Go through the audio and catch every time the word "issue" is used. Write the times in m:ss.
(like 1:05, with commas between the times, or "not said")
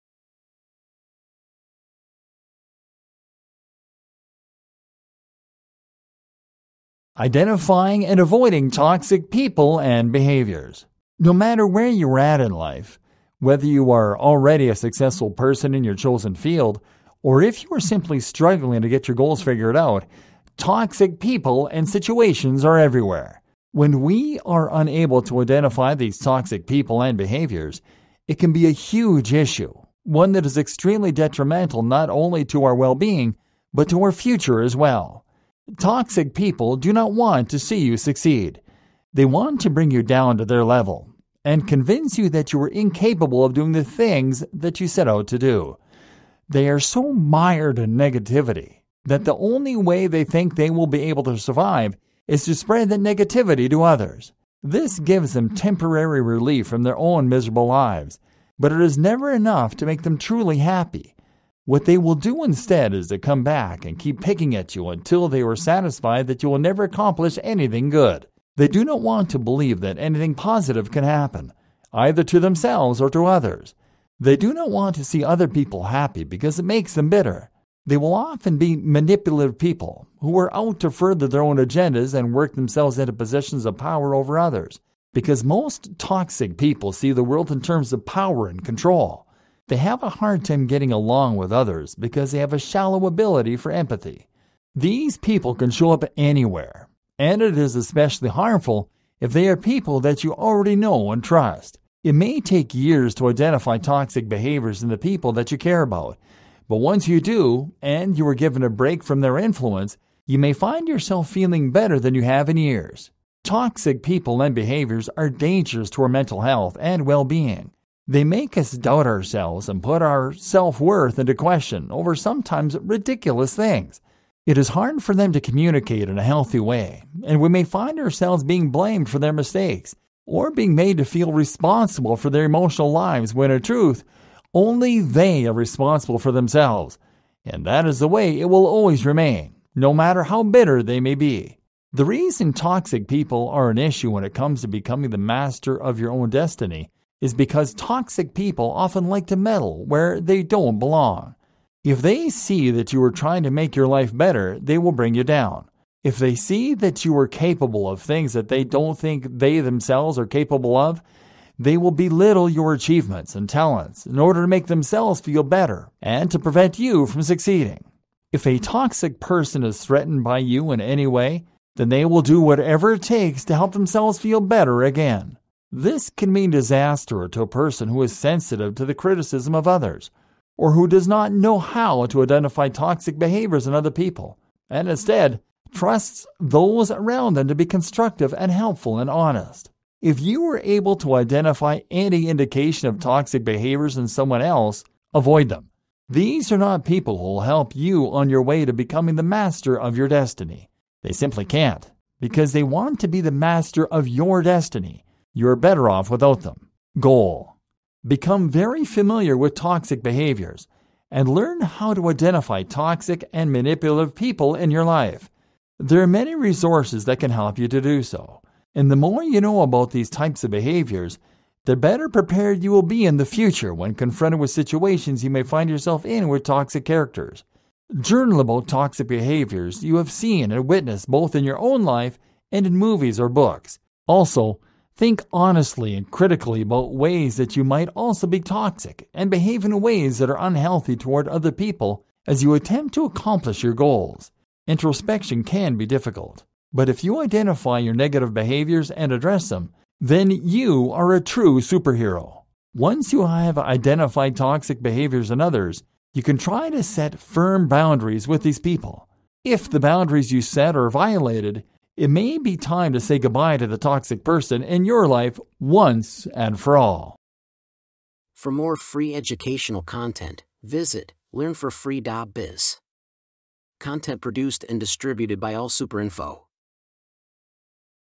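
0:29, 2:23.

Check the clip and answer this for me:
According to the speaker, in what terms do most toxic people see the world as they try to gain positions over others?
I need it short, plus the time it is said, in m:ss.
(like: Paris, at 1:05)
power and control, at 1:28.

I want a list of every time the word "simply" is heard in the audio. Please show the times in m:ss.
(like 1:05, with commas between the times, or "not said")
0:17, 3:21.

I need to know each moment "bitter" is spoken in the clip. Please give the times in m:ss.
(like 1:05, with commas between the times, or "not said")
1:17, 2:20.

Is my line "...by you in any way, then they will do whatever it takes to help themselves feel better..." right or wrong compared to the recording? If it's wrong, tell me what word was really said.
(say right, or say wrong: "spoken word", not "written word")
right.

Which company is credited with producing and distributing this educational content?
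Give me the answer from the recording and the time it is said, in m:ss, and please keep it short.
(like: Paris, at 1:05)
AllSuperInfo, at 4:35.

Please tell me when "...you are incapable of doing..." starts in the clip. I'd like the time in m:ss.
0:42.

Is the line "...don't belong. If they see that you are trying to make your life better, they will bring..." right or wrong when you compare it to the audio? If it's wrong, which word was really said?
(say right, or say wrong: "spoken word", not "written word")
right.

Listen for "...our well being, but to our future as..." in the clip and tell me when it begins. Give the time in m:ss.
0:32.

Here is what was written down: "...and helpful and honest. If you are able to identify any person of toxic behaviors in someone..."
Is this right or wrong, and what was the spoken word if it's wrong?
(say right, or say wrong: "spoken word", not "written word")
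wrong: "indication", not "person".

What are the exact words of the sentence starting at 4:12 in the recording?
Once you have identified toxic behaviors in others, you can try to set firm boundaries with these people.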